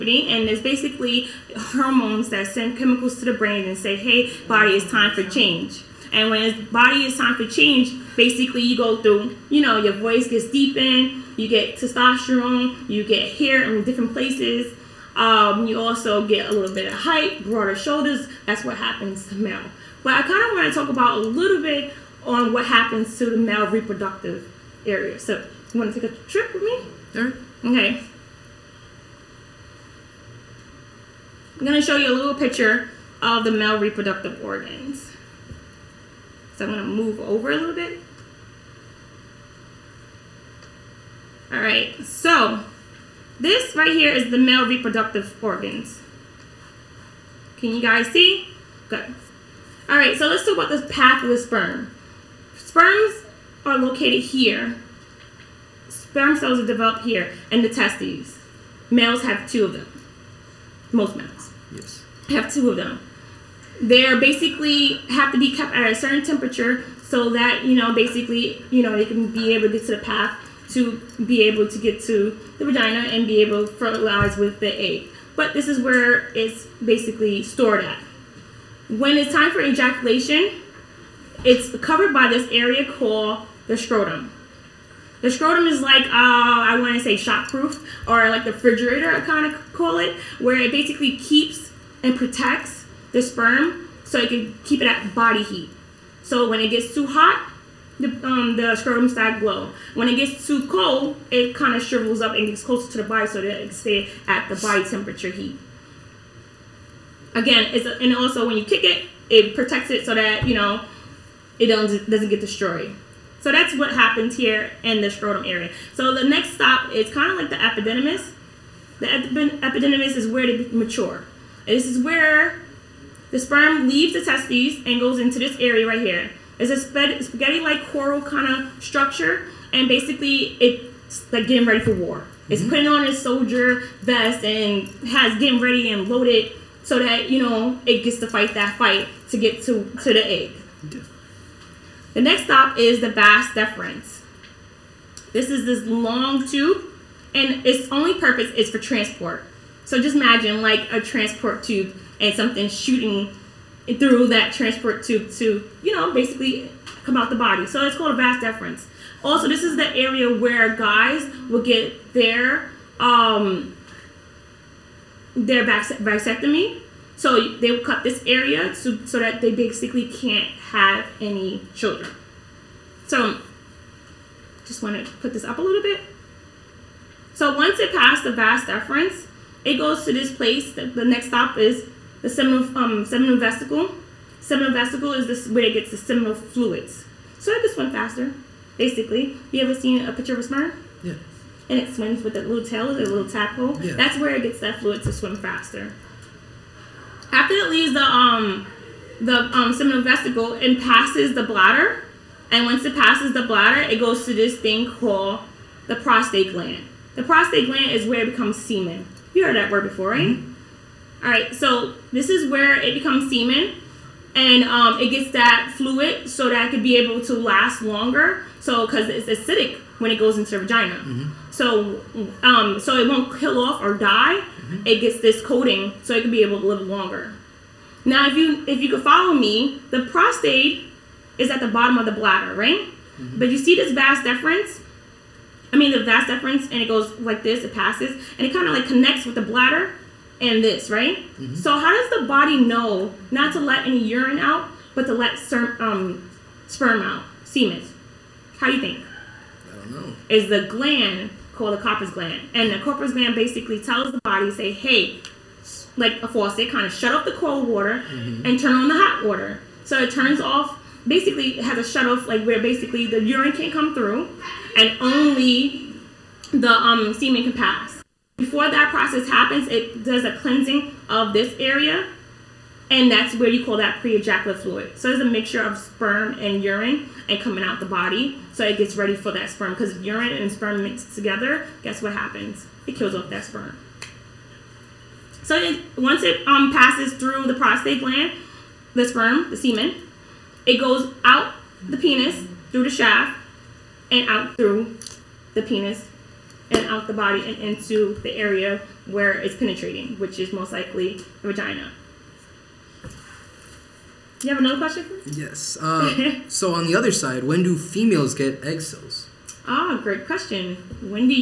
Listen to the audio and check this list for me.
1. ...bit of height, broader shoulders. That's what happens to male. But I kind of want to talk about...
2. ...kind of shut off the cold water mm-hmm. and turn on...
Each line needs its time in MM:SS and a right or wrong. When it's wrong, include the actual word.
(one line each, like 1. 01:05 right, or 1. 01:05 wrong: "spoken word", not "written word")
1. 00:16 right
2. 04:16 right.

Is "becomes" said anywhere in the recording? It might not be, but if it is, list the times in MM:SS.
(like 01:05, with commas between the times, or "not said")
03:28, 03:32.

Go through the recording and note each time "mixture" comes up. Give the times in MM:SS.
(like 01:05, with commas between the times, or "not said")
04:35.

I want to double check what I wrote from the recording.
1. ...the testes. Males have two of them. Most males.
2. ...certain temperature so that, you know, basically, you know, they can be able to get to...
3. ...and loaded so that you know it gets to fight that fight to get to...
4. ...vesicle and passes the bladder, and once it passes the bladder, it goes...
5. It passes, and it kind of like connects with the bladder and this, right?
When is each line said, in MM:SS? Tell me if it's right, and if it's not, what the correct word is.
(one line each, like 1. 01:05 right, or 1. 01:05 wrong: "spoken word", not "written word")
1. 00:57 right
2. 01:05 right
3. 02:15 right
4. 03:20 right
5. 03:57 right.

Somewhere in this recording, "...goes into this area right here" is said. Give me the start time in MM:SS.
02:04.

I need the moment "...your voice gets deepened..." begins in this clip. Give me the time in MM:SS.
00:09.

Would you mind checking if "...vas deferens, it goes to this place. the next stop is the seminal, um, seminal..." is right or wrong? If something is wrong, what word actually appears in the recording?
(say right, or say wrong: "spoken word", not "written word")
right.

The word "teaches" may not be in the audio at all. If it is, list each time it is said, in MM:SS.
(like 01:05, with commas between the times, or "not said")
not said.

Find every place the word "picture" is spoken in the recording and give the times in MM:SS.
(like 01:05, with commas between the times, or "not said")
00:32, 03:10.